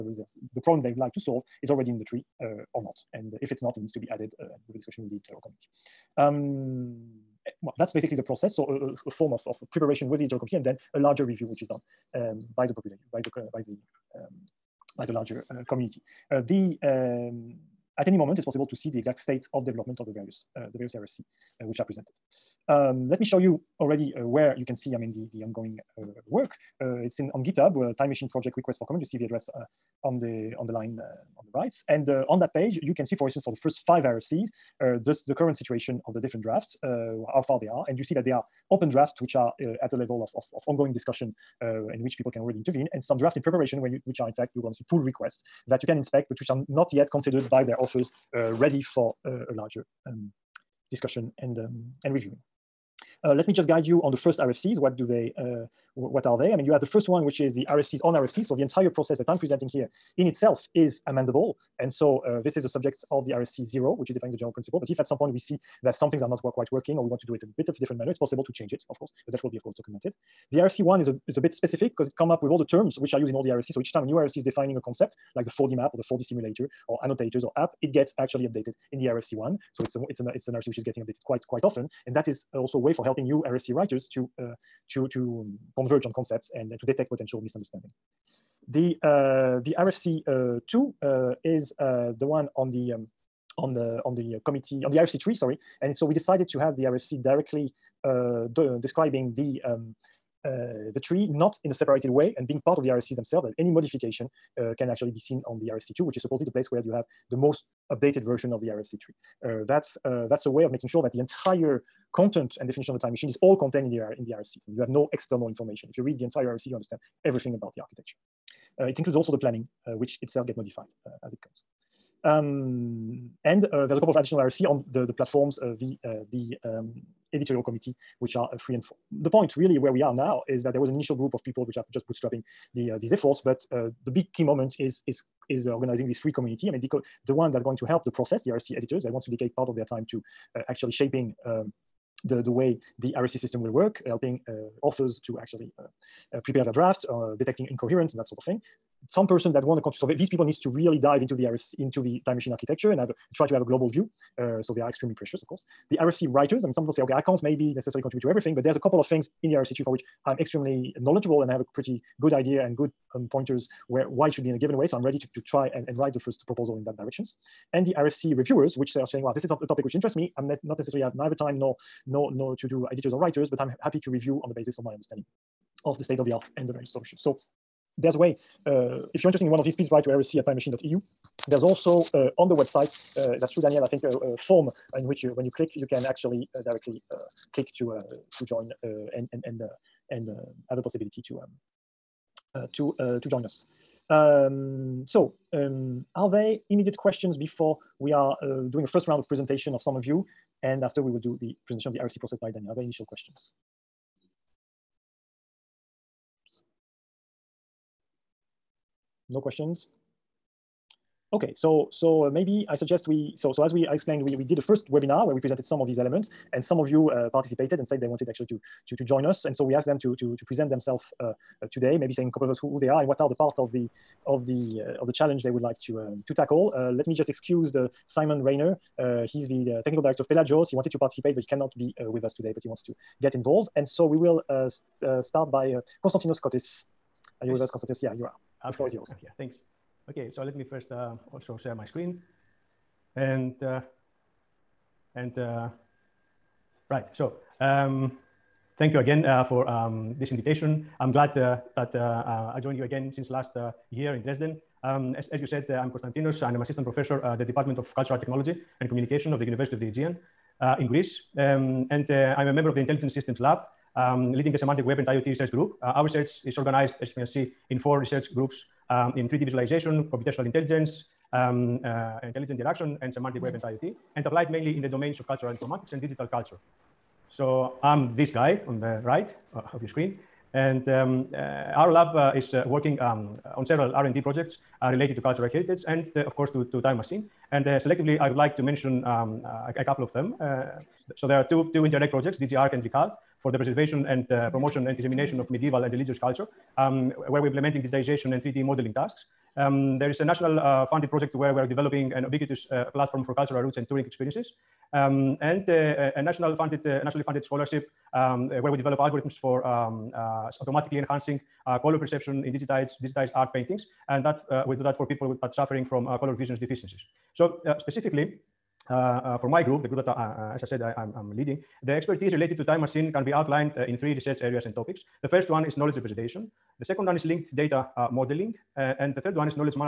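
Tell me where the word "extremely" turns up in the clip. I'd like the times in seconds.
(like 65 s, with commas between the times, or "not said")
154 s, 160 s.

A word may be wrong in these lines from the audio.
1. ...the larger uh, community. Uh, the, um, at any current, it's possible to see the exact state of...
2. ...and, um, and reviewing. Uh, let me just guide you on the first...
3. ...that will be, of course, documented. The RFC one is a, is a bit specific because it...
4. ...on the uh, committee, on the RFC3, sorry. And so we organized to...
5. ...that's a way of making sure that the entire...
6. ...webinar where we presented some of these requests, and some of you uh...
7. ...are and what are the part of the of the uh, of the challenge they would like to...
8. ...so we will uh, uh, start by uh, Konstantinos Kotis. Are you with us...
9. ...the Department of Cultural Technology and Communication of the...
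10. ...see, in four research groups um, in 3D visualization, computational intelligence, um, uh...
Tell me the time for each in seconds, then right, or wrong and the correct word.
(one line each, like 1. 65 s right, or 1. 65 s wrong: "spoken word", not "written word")
1. 15 s wrong: "moment", not "current"
2. 51 s right
3. 69 s right
4. 94 s wrong: "decided", not "organized"
5. 110 s right
6. 214 s wrong: "elements", not "requests"
7. 222 s right
8. 233 s right
9. 257 s right
10. 267 s right.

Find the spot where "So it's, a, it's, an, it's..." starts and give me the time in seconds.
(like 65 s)
79 s.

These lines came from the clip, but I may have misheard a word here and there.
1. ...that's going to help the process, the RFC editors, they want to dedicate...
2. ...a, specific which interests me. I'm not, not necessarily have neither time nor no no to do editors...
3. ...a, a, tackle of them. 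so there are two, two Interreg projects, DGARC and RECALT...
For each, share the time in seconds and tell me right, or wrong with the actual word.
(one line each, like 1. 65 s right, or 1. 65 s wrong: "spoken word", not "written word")
1. 137 s right
2. 169 s wrong: "topic", not "specific"
3. 289 s wrong: "couple", not "tackle".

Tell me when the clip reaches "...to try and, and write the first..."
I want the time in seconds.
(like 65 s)
165 s.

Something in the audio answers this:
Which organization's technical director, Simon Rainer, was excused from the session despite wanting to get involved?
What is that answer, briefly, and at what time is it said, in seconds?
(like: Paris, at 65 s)
Pelagios, at 230 s.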